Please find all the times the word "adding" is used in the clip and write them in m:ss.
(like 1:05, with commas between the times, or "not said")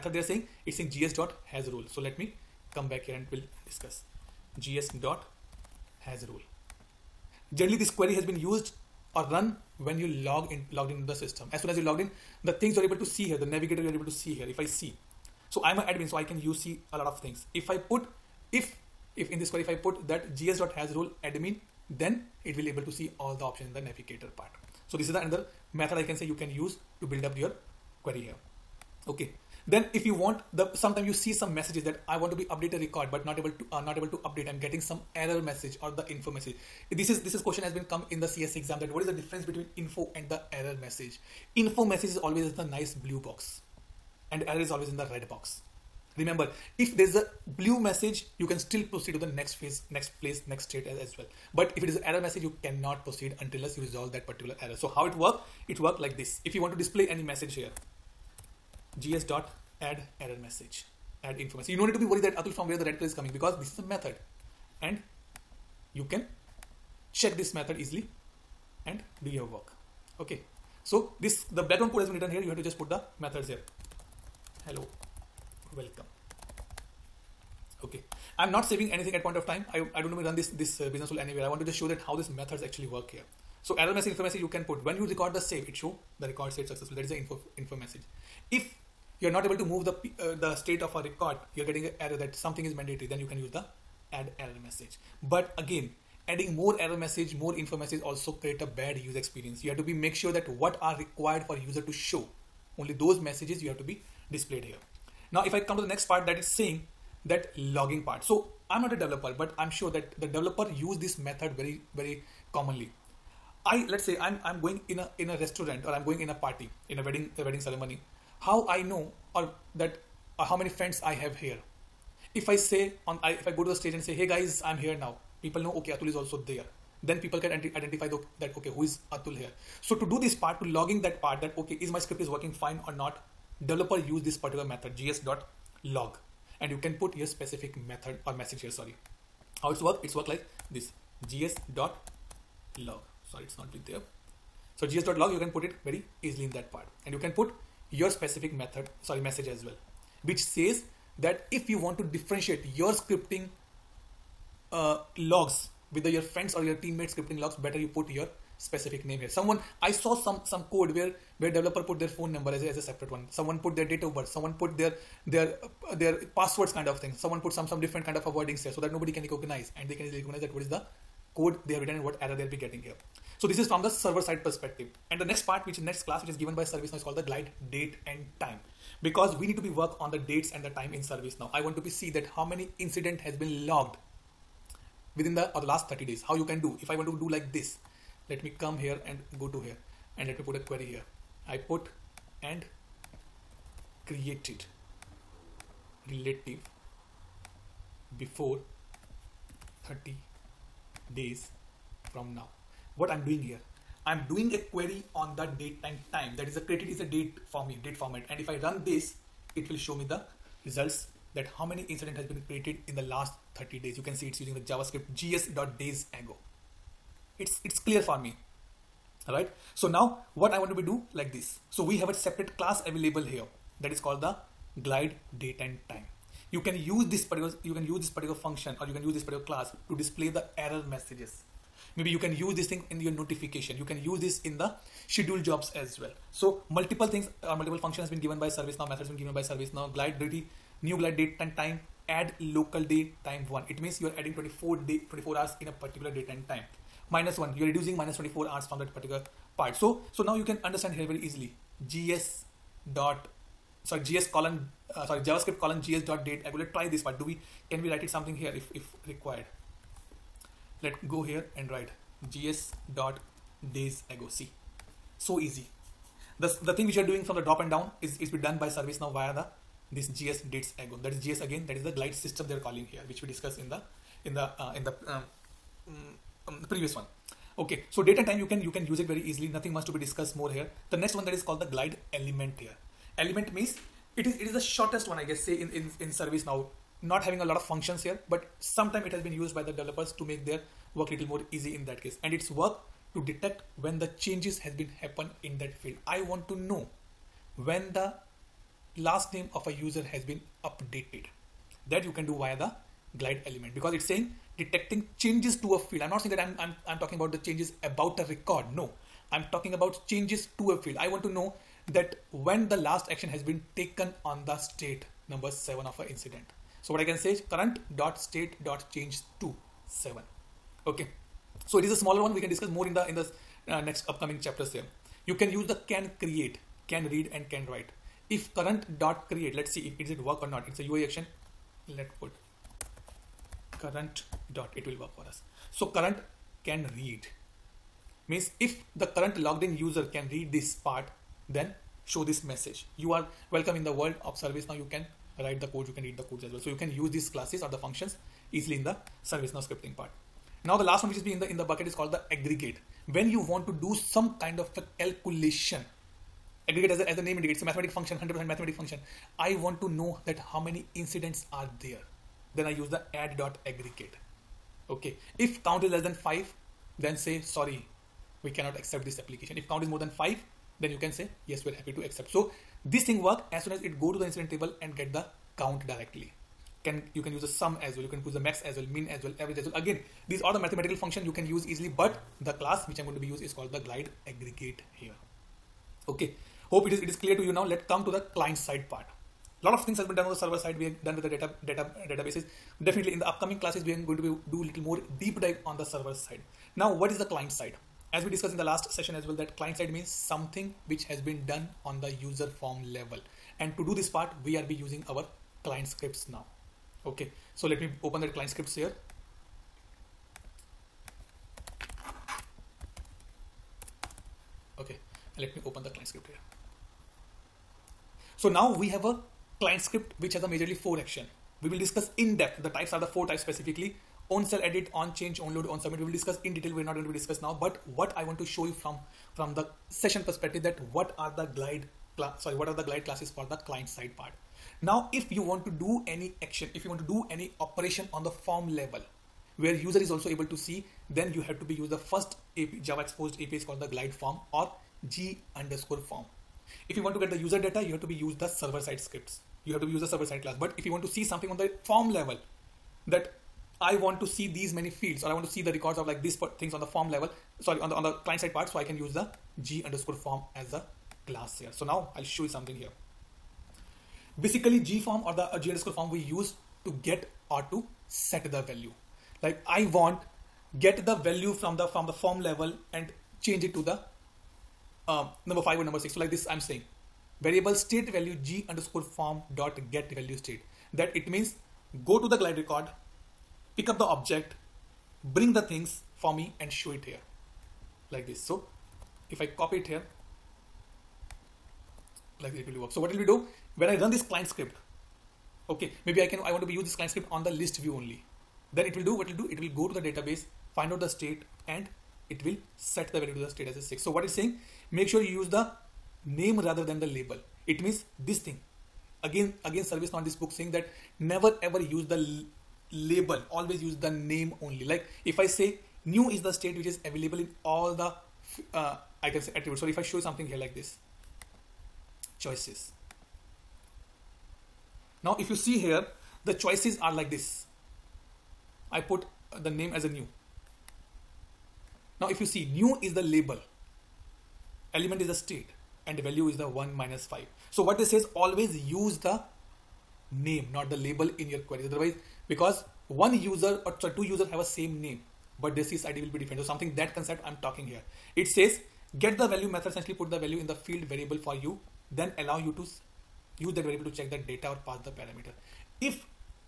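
1:36, 4:04.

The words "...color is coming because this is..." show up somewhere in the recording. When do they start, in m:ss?
1:02.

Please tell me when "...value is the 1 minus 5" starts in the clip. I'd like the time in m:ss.
8:56.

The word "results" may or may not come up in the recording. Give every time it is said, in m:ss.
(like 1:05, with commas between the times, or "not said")
3:30.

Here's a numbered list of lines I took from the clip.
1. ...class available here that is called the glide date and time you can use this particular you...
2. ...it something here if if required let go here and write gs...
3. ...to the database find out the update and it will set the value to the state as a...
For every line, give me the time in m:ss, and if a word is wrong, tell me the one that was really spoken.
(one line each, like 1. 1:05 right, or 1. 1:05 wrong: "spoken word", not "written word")
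1. 3:42 right
2. 4:18 right
3. 8:19 wrong: "state", not "update".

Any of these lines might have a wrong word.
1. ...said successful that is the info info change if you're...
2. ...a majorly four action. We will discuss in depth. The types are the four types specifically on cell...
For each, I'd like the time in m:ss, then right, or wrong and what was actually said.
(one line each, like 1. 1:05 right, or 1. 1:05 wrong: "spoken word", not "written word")
1. 1:26 wrong: "message", not "change"
2. 7:00 right.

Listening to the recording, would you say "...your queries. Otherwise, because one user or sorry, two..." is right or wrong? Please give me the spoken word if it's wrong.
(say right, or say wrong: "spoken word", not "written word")
right.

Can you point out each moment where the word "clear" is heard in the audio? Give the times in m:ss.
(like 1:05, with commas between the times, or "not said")
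3:37, 6:27.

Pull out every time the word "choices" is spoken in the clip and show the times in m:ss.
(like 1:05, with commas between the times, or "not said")
8:42, 8:46.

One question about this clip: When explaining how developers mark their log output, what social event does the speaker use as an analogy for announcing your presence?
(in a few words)
wedding ceremony.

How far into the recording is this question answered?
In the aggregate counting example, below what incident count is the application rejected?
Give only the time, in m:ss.
6:05.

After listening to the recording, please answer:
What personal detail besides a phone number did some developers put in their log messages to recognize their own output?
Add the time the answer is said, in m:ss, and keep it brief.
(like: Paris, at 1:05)
date of birth, at 2:43.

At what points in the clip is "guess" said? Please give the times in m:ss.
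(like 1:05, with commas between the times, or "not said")
4:45.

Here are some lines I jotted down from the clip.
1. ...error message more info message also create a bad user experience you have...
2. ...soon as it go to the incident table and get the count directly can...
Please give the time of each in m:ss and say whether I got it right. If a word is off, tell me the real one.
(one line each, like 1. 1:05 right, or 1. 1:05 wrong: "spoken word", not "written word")
1. 1:36 right
2. 6:13 right.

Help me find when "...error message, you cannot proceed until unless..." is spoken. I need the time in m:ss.
0:52.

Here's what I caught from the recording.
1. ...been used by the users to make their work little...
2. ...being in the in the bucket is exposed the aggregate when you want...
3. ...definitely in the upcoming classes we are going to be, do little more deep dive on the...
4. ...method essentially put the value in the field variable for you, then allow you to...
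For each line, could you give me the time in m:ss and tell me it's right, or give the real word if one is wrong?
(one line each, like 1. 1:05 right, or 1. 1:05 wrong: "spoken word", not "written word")
1. 4:49 wrong: "developers", not "users"
2. 5:51 wrong: "called", not "exposed"
3. 6:32 right
4. 9:09 right.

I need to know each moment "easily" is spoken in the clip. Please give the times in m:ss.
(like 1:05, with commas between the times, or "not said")
1:07, 2:26, 4:11, 4:39, 5:48, 6:21.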